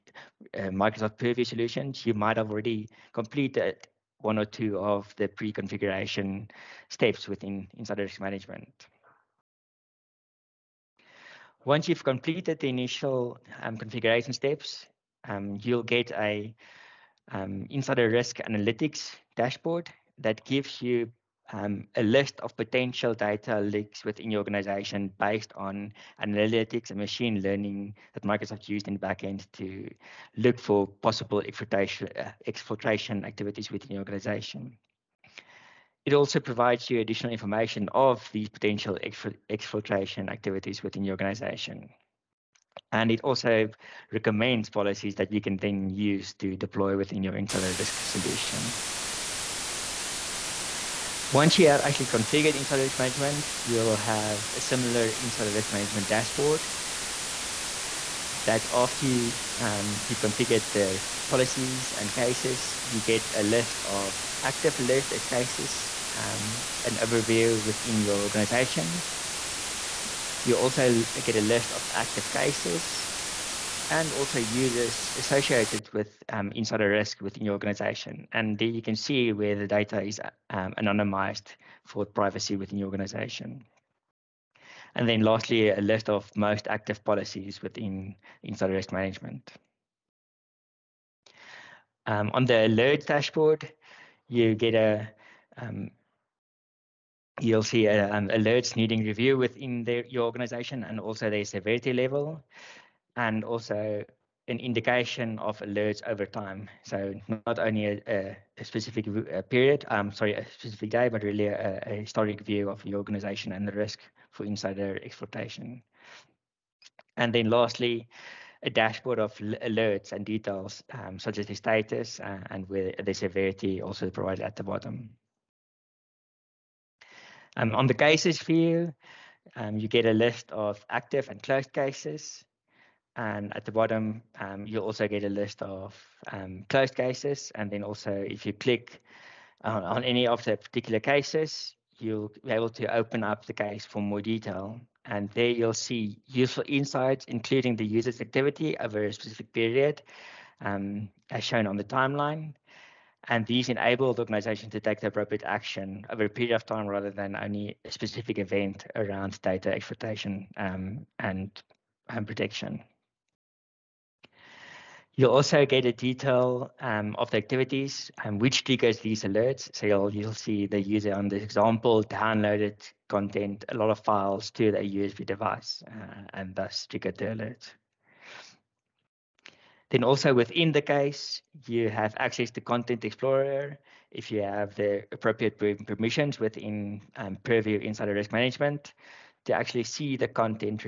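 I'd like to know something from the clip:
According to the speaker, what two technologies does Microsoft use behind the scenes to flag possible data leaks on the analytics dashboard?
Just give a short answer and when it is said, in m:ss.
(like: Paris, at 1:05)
Analytics and machine learning, at 0:26.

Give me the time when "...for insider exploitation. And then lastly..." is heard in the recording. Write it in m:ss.
1:54.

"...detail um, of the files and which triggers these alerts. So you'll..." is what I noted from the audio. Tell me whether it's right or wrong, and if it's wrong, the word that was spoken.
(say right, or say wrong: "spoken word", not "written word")
wrong: "activities", not "files".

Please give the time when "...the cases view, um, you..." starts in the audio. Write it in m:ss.
2:07.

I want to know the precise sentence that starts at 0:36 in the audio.
It also provides you additional information of these potential exfiltration activities within your organization.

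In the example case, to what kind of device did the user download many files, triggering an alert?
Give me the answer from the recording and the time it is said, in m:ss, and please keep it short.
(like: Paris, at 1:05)
USB device, at 2:54.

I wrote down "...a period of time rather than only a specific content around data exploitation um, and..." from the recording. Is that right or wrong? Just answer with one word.
wrong.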